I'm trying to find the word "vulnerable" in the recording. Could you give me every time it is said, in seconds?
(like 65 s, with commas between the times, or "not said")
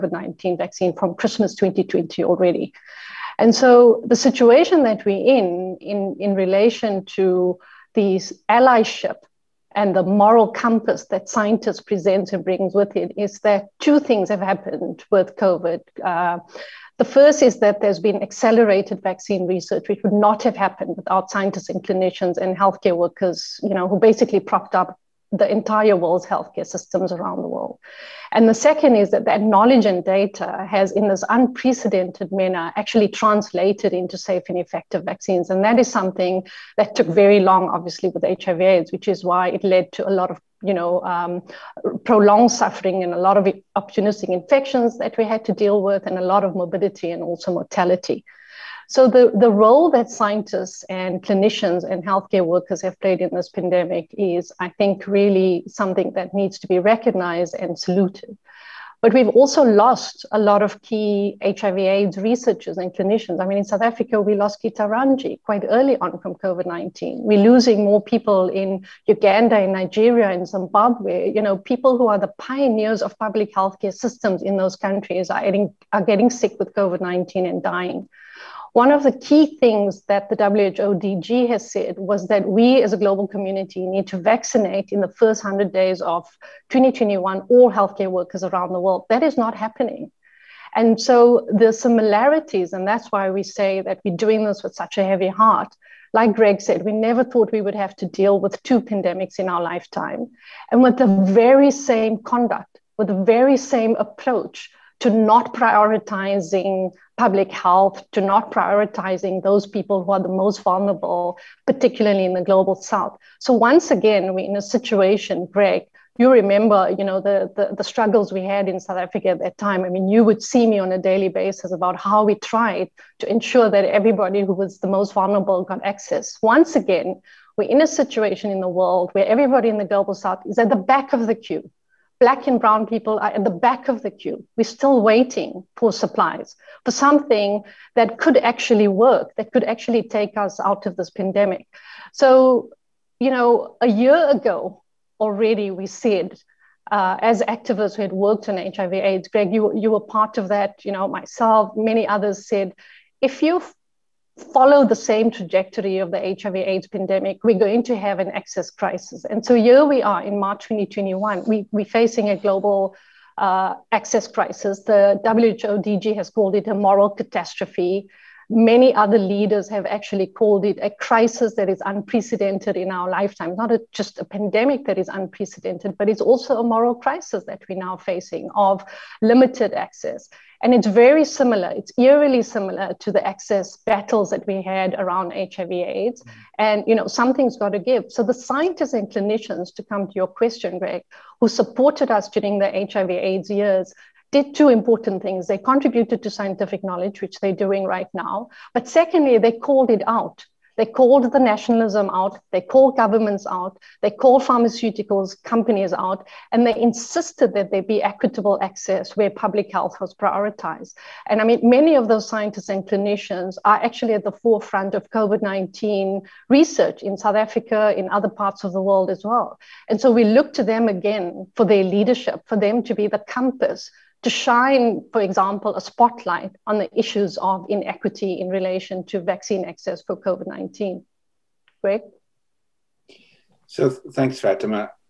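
110 s, 125 s.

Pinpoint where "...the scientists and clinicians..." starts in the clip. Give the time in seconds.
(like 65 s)
188 s.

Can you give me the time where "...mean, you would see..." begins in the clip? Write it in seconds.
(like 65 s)
119 s.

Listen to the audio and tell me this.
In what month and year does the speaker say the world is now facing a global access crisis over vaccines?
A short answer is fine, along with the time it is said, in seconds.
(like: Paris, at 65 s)
March 2021, at 160 s.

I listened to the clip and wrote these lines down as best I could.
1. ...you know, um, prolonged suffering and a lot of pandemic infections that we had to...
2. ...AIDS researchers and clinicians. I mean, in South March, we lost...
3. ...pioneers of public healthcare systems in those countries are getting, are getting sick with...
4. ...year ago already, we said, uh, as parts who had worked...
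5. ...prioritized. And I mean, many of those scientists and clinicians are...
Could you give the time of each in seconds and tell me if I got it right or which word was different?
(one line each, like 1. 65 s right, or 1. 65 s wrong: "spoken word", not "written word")
1. 40 s wrong: "opportunistic", not "pandemic"
2. 61 s wrong: "Africa", not "March"
3. 72 s right
4. 143 s wrong: "activists", not "parts"
5. 210 s right.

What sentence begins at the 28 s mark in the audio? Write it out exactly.
And the second is that that knowledge and data has, in this unprecedented manner, actually translated into safe and effective vaccines.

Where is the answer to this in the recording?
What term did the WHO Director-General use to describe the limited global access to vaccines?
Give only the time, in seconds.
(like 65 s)
166 s.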